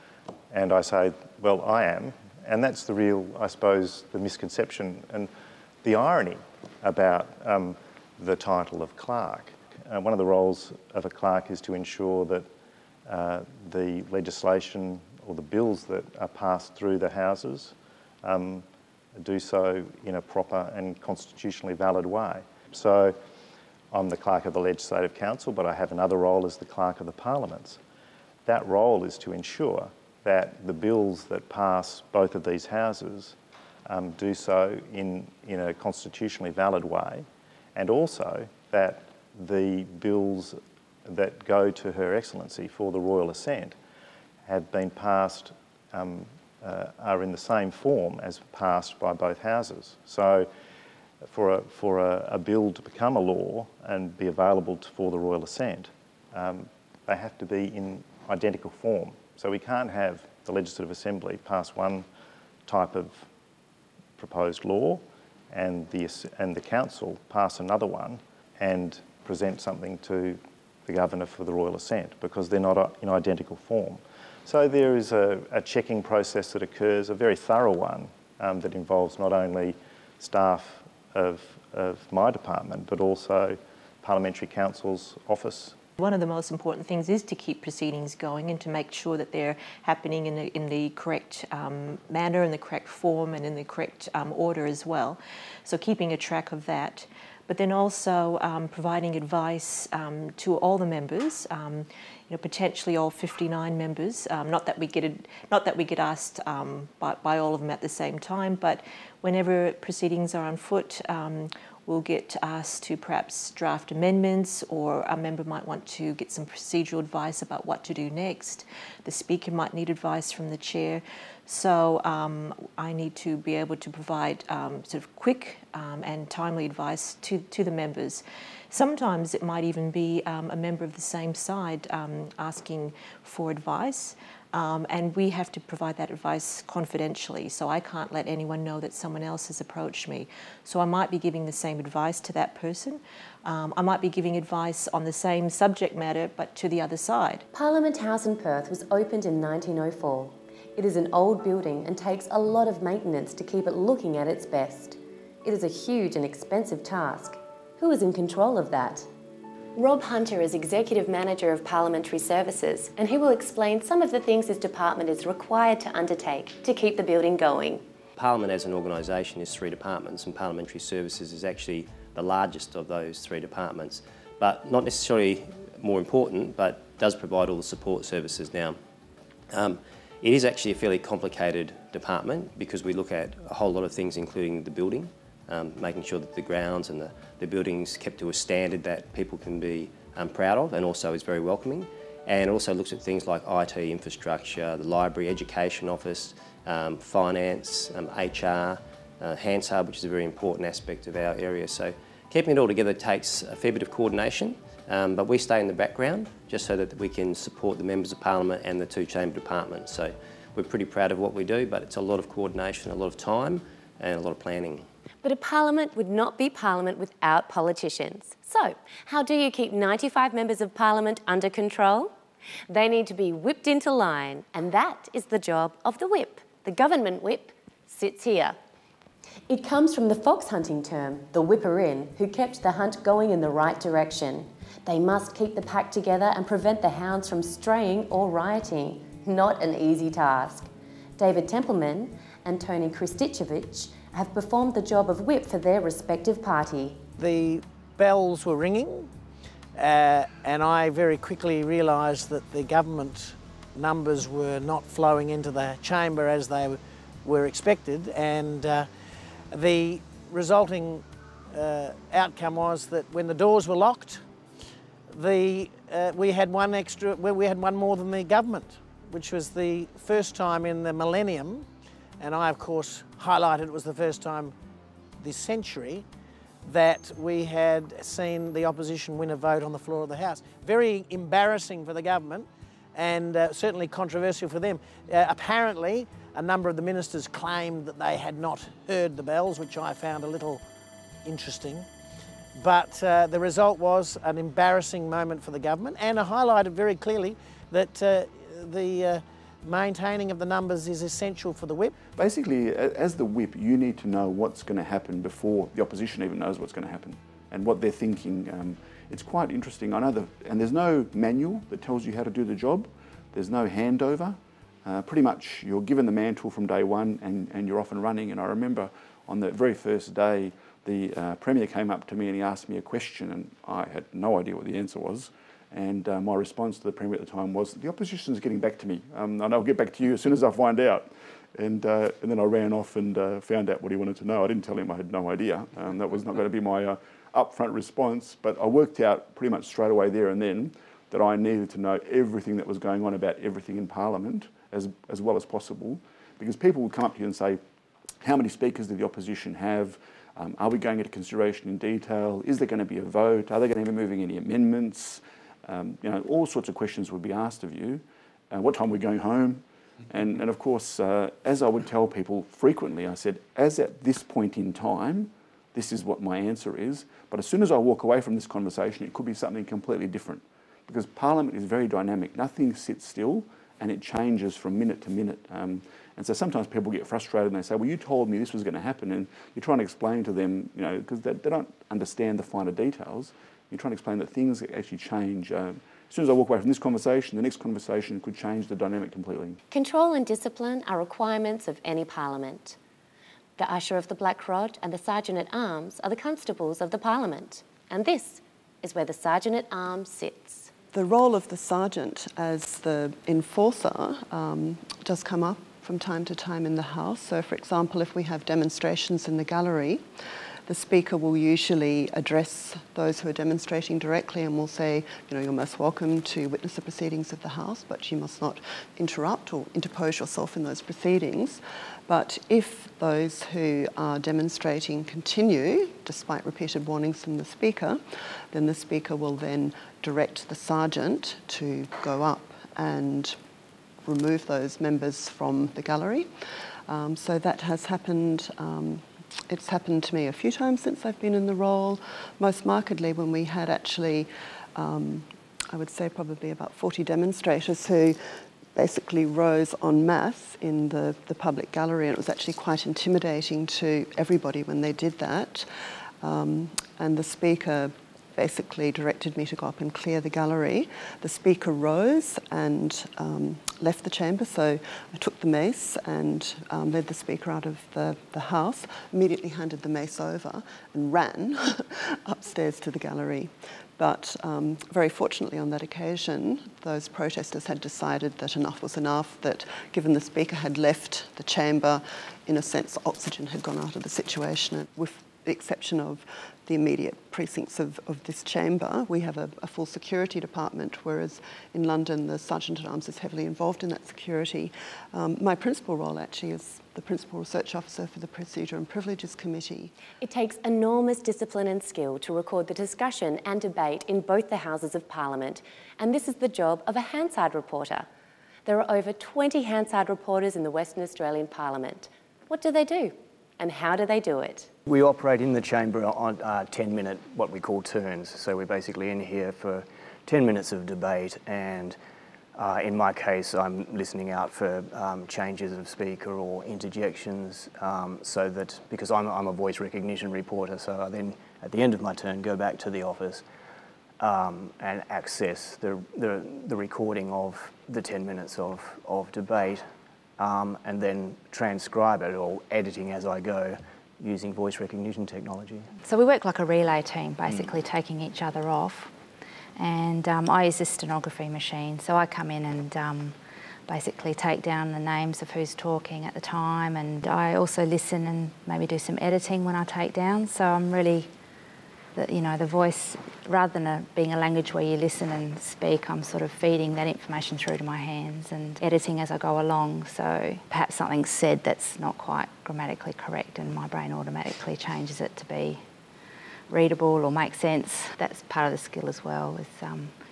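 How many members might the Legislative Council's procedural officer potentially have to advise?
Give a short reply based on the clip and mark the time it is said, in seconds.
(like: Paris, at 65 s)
59, at 103 s.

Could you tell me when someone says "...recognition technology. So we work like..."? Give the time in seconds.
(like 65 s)
544 s.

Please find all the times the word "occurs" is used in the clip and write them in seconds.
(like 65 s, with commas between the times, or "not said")
76 s.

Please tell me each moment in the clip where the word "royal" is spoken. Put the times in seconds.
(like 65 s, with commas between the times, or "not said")
42 s, 55 s, 71 s.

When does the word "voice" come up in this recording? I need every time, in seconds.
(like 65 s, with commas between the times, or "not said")
529 s, 544 s, 562 s.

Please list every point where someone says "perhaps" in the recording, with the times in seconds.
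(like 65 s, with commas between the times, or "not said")
112 s, 570 s.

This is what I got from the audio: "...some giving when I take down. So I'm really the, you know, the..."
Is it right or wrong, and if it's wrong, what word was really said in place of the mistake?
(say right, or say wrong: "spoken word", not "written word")
wrong: "editing", not "giving".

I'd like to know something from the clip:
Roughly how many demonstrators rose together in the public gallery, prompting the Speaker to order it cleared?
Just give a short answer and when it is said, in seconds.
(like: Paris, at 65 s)
40, at 446 s.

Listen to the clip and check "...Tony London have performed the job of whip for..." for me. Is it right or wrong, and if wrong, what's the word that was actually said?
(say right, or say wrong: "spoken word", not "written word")
wrong: "Krsticevic", not "London".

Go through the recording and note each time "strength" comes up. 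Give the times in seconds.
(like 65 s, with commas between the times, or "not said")
not said.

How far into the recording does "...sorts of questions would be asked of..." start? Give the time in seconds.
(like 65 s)
356 s.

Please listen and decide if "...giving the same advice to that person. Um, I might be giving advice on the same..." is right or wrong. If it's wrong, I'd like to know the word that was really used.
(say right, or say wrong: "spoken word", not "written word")
right.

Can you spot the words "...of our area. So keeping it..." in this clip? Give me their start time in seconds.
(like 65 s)
201 s.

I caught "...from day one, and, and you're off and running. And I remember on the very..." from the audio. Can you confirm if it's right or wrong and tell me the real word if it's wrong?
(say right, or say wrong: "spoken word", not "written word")
right.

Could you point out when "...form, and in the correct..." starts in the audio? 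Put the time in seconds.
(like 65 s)
92 s.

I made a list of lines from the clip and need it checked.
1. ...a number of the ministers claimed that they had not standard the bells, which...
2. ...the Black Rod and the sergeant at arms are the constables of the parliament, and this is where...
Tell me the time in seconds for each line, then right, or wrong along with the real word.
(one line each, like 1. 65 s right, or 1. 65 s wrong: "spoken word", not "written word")
1. 286 s wrong: "heard", not "standard"
2. 394 s right.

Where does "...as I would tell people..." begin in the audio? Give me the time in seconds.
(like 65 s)
361 s.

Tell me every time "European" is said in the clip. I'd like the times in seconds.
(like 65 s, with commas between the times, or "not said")
not said.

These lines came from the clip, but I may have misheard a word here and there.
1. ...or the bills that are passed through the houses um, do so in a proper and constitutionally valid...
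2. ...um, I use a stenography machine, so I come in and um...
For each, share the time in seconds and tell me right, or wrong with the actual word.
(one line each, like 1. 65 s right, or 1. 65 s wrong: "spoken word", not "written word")
1. 15 s right
2. 550 s right.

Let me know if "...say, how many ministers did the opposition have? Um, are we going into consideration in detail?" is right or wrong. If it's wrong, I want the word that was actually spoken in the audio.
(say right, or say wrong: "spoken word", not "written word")
wrong: "speakers", not "ministers".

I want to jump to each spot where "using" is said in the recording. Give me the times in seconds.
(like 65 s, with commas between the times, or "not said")
544 s.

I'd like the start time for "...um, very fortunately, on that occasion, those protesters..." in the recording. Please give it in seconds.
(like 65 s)
474 s.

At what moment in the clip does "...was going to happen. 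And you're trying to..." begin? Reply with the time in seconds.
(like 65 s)
378 s.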